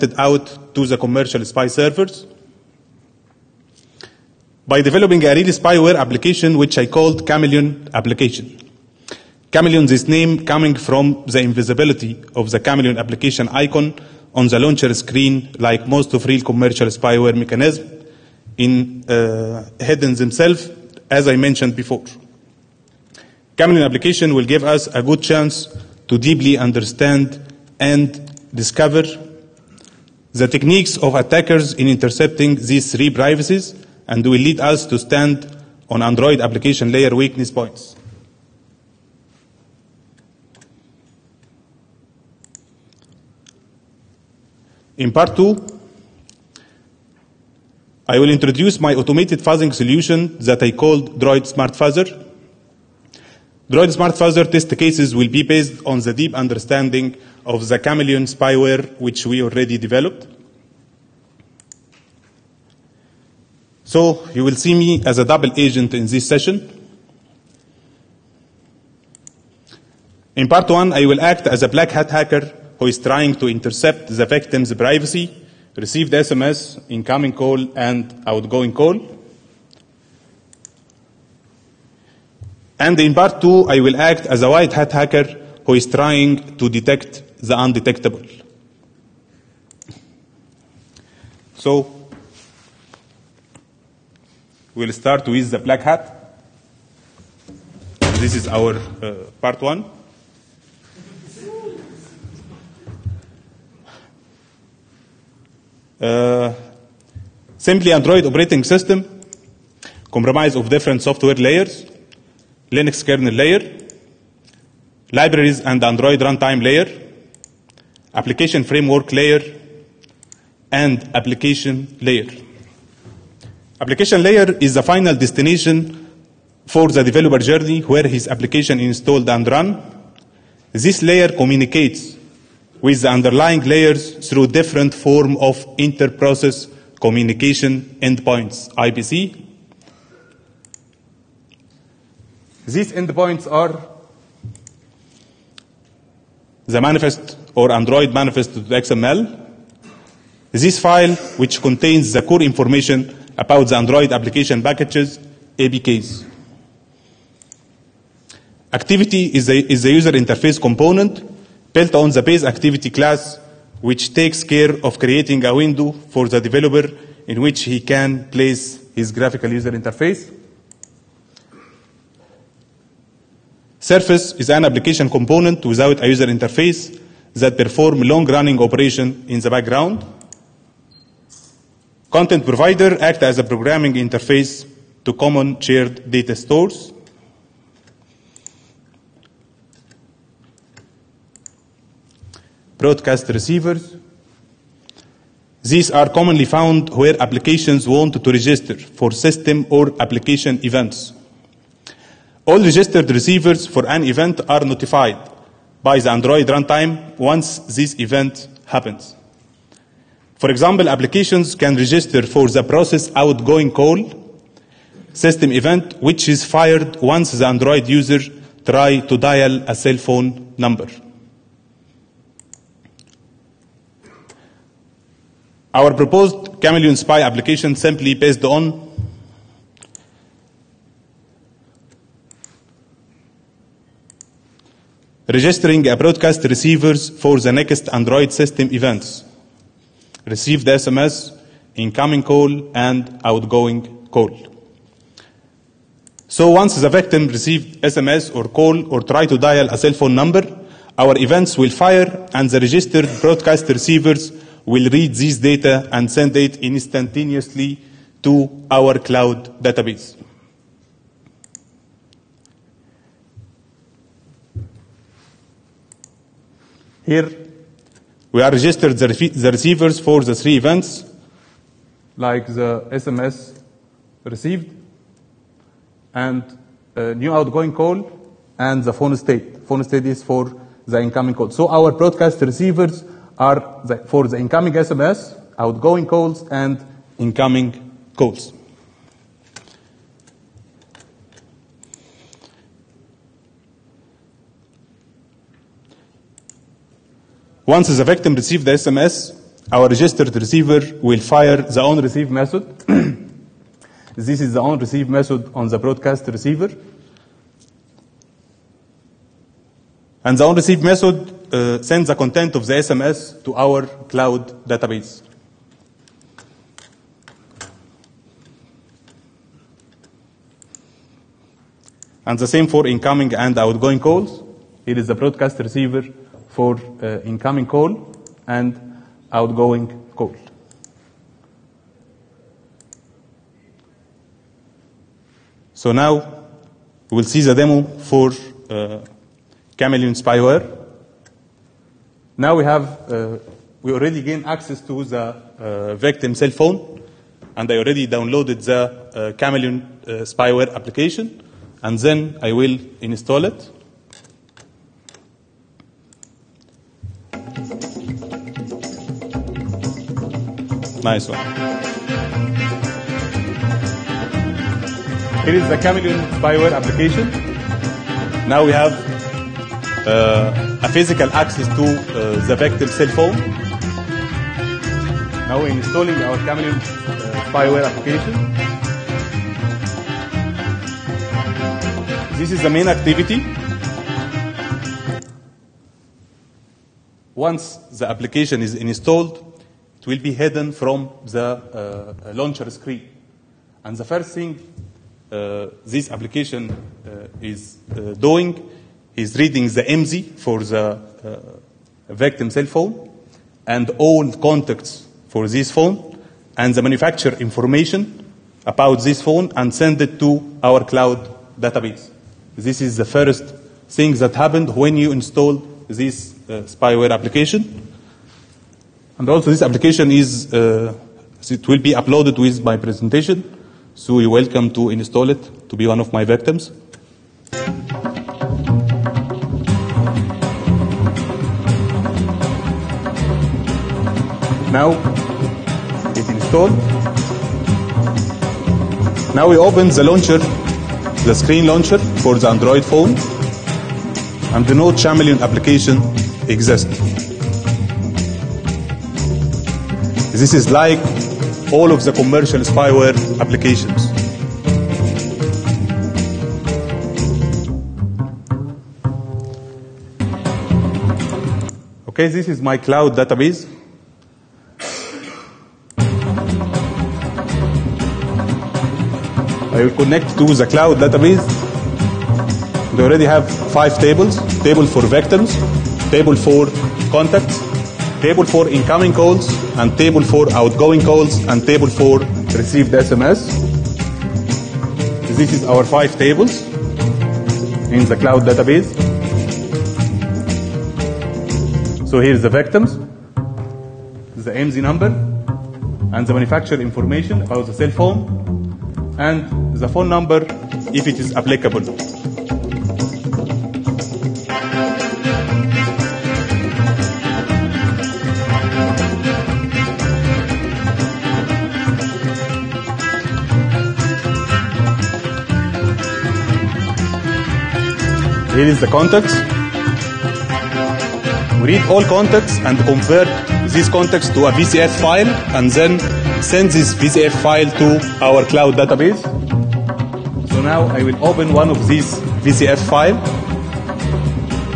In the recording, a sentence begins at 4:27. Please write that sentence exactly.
Here, we are registered the receivers for the three events, like the SMS received, and new outgoing call, and the phone state.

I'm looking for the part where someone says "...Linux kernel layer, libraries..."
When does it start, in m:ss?
1:52.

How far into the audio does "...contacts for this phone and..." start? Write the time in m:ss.
6:44.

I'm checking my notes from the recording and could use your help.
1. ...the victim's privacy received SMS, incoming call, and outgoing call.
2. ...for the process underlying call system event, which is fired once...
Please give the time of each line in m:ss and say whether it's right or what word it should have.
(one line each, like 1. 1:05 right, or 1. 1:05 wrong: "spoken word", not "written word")
1. 1:14 right
2. 3:32 wrong: "outgoing", not "underlying".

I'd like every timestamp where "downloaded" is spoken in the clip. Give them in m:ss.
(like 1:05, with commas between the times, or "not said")
5:48.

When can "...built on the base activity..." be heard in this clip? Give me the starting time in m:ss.
2:41.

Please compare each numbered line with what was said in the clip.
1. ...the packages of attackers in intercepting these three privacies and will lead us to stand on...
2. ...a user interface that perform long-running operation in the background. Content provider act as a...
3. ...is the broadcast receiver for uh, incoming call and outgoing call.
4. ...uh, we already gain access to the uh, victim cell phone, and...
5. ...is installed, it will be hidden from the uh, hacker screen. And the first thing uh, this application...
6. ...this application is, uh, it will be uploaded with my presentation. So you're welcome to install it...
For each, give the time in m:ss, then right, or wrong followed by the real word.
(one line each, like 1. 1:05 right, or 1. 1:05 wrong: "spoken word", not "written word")
1. 0:30 wrong: "techniques", not "packages"
2. 2:56 right
3. 5:24 right
4. 5:43 right
5. 6:28 wrong: "launcher", not "hacker"
6. 6:59 right.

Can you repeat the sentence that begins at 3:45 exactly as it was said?
Our proposed Chameleon Spy application simply based on registering a broadcast receivers for the next Android system events.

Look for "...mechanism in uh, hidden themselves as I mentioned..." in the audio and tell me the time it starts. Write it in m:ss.
0:17.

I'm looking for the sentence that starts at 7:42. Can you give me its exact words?
Okay, this is my cloud database.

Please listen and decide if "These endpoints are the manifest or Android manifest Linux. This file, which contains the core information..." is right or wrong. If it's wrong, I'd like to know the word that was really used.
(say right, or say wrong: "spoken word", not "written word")
wrong: "XML", not "Linux".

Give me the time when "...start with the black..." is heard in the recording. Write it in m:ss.
1:34.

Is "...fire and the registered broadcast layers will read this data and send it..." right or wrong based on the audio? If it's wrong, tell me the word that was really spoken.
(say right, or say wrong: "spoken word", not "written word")
wrong: "receivers", not "layers".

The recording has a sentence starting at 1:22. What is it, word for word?
And in part two, I will act as a white hat hacker who is trying to detect the undetectable.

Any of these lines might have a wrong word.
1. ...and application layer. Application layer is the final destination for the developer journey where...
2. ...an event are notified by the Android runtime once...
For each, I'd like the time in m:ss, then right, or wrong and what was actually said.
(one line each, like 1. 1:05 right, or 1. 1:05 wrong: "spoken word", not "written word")
1. 2:00 right
2. 3:23 right.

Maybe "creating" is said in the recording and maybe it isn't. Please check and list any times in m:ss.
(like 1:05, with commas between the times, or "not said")
2:44.